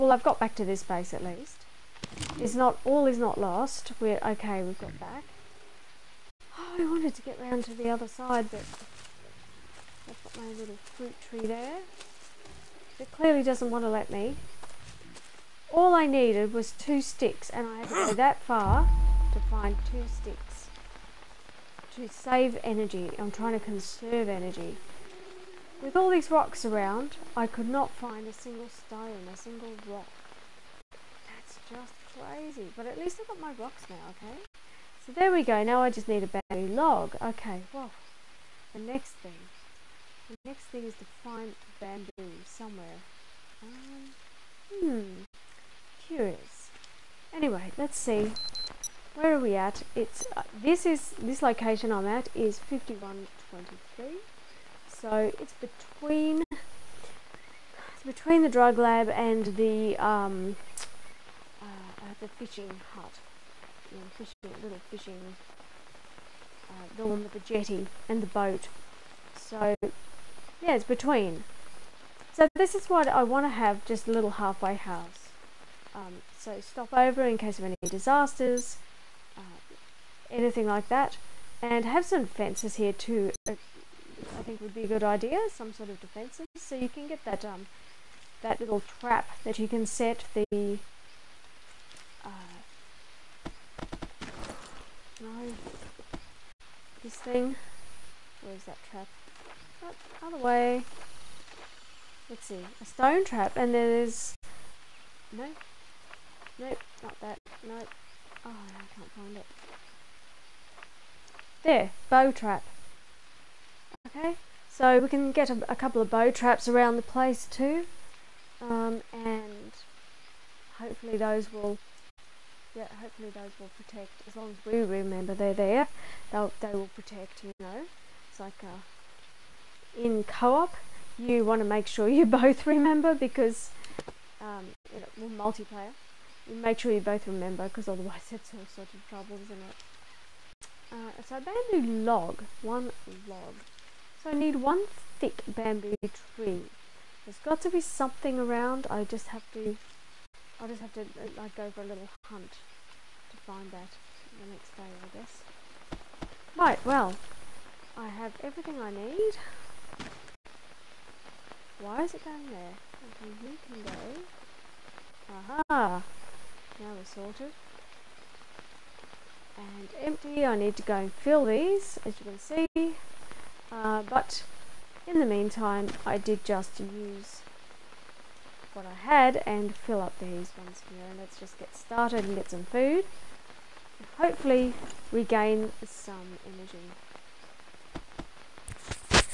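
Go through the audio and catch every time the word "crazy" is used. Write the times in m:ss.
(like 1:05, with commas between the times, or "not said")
0:32.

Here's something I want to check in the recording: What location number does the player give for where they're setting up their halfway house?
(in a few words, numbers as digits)
5123.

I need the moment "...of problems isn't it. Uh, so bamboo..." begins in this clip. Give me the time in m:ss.
2:18.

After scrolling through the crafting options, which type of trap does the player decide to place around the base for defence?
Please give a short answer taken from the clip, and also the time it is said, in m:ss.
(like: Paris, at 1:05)
bow trap, at 1:52.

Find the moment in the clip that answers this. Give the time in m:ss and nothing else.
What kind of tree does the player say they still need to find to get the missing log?
2:25.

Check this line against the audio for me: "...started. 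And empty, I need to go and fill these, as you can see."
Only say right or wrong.
wrong.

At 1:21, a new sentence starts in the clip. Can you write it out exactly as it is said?
And have some fences here too, uh, I think would be a good idea, some sort of defences.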